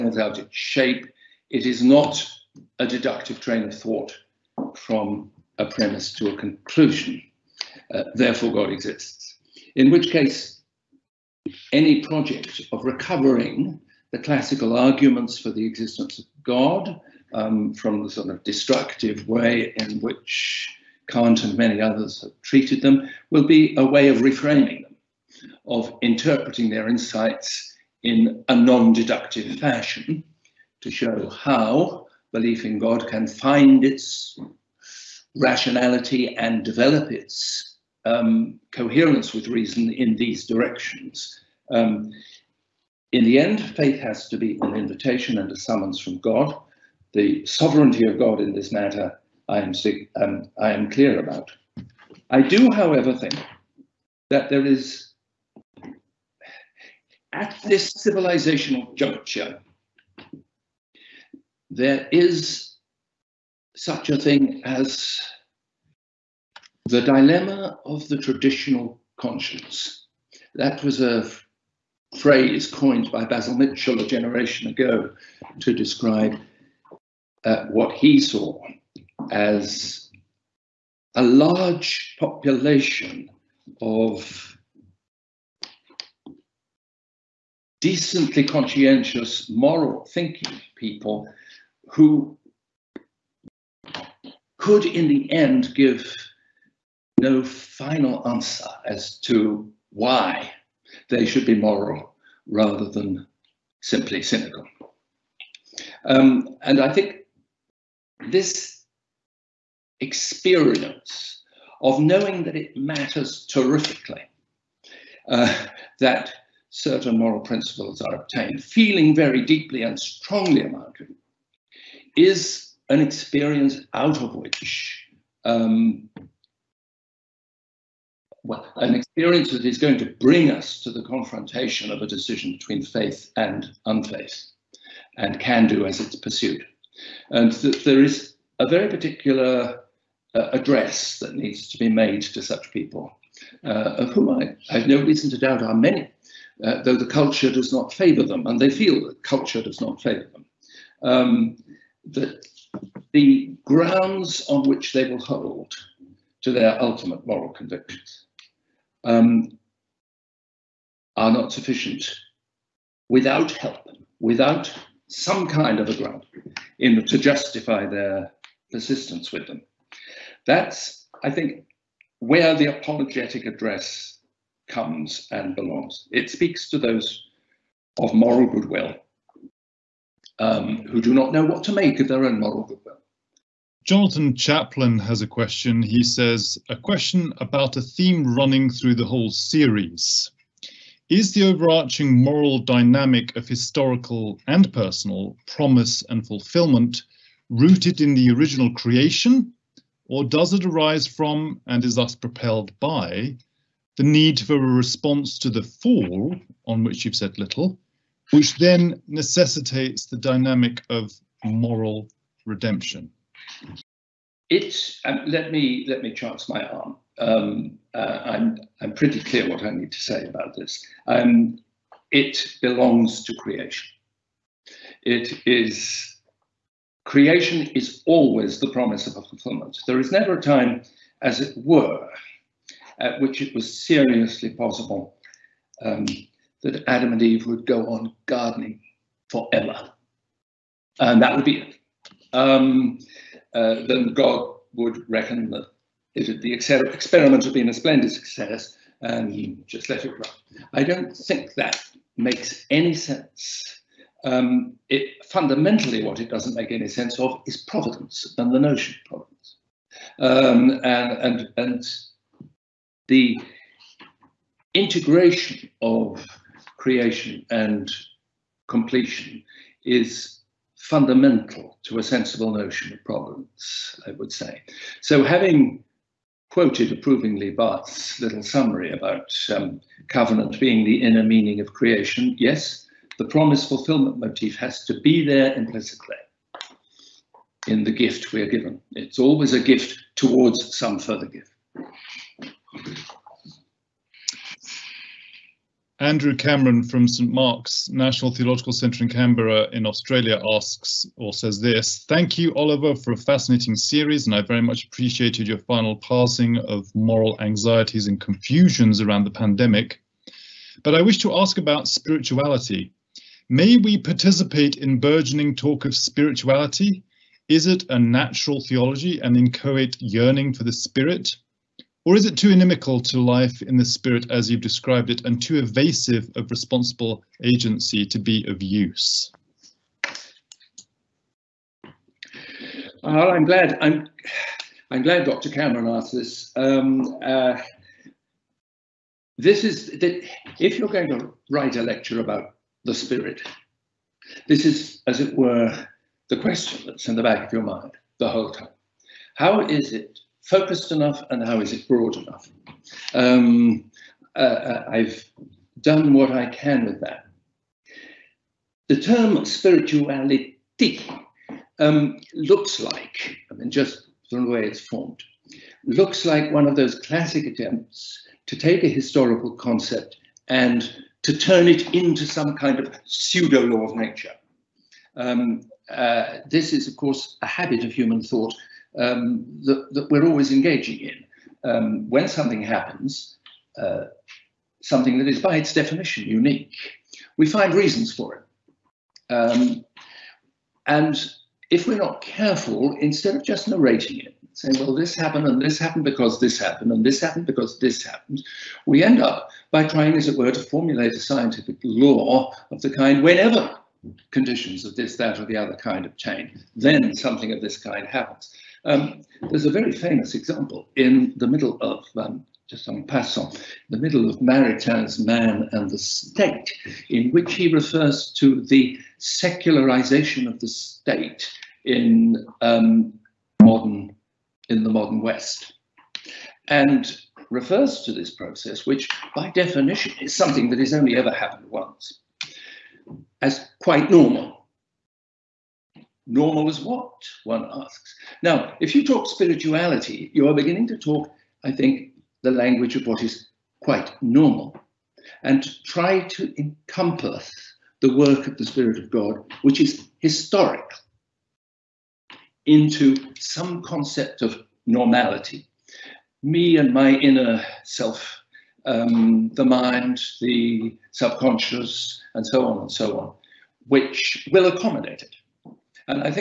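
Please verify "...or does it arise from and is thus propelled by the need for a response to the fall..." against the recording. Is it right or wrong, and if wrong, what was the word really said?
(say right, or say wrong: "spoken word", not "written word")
right.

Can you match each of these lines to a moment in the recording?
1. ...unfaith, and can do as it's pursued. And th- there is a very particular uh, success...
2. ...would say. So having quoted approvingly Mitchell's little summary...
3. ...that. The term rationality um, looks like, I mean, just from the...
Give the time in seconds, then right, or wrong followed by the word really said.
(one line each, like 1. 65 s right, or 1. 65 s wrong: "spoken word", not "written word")
1. 133 s wrong: "address", not "success"
2. 274 s wrong: "Barth", not "Mitchell"
3. 357 s wrong: "spirituality", not "rationality".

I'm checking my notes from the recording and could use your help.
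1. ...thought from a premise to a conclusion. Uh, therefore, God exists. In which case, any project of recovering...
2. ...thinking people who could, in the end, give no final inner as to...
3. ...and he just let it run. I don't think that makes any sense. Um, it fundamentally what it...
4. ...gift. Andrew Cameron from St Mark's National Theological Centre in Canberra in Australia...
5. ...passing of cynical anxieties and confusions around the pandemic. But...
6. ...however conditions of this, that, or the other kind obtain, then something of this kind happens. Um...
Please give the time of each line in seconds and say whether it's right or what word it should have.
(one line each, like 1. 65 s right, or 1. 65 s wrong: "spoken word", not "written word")
1. 3 s right
2. 90 s wrong: "answer", not "inner"
3. 249 s right
4. 291 s right
5. 305 s wrong: "moral", not "cynical"
6. 403 s wrong: "whenever", not "however".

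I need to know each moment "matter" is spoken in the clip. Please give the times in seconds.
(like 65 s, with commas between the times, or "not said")
48 s, 112 s.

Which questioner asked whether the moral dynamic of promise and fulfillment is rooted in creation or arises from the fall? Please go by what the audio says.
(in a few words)
Jonathan Chaplin.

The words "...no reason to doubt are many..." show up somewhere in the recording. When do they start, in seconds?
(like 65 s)
144 s.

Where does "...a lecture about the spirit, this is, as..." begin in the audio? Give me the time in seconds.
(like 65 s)
341 s.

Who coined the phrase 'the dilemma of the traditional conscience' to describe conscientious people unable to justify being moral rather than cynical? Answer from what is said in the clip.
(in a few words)
Basil Mitchell.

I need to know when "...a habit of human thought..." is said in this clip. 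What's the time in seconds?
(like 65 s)
377 s.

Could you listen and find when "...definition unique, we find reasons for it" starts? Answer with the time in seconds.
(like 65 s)
385 s.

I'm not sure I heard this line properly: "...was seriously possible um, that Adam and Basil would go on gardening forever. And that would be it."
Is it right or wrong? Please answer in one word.
wrong.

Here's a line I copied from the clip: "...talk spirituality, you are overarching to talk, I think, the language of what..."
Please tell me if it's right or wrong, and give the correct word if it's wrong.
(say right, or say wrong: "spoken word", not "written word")
wrong: "beginning", not "overarching".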